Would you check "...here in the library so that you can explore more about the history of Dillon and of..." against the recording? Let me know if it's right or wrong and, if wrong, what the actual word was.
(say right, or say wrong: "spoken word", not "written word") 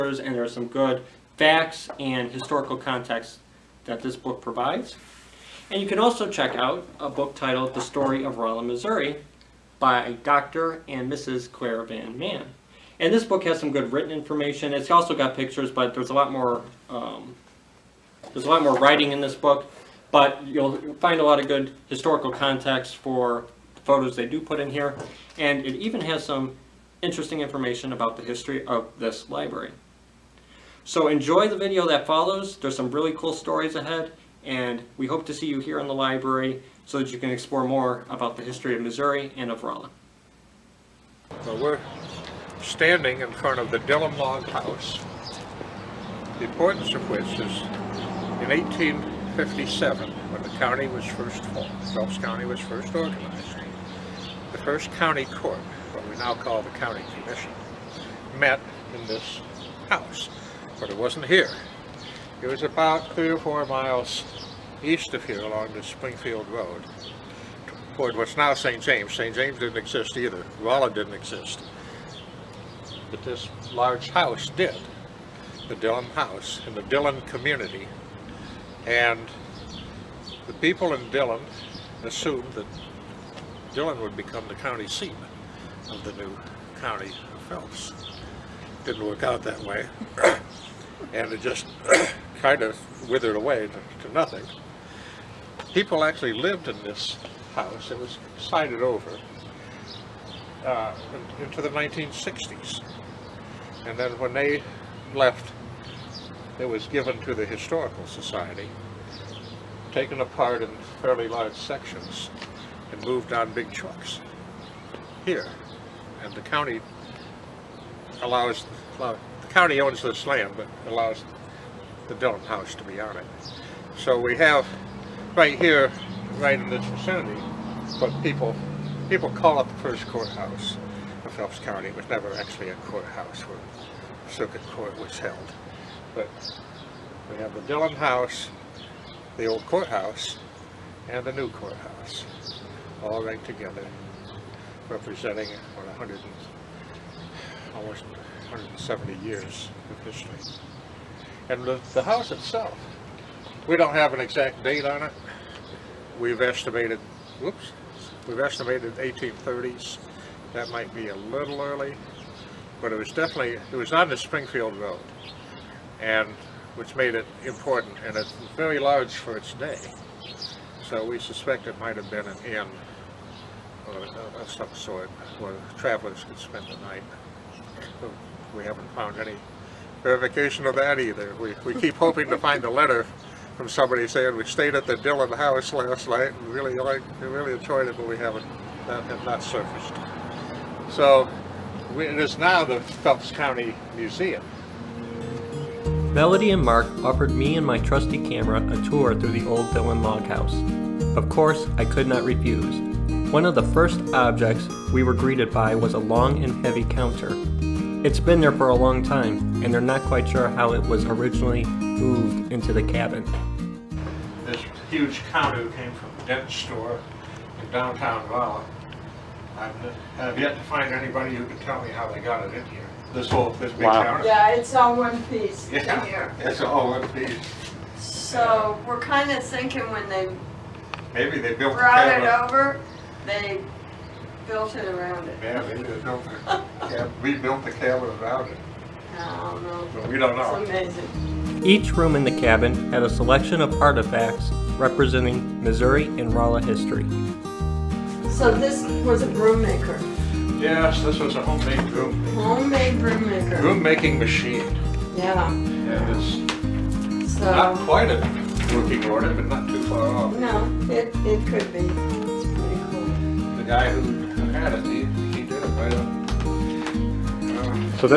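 wrong: "Missouri", not "Dillon".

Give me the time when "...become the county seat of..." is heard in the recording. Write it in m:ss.
1:24.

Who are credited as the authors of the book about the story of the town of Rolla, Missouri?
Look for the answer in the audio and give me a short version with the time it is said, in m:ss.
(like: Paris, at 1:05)
Dr. and Mrs. Clair V. Mann, at 0:10.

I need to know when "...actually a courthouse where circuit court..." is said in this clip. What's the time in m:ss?
2:12.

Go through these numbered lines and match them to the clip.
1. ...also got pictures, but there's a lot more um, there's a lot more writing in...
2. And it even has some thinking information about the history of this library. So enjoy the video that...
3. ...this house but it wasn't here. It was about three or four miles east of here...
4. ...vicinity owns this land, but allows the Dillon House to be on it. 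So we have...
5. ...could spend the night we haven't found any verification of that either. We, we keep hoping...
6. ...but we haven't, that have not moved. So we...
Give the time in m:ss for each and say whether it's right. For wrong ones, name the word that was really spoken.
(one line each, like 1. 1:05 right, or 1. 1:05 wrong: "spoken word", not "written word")
1. 0:14 right
2. 0:25 wrong: "interesting", not "thinking"
3. 0:59 right
4. 1:59 wrong: "county", not "vicinity"
5. 2:56 right
6. 3:07 wrong: "surfaced", not "moved".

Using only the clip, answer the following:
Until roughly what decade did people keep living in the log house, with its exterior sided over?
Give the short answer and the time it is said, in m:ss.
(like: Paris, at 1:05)
1960s, at 1:41.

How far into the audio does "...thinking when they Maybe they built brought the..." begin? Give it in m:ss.
3:49.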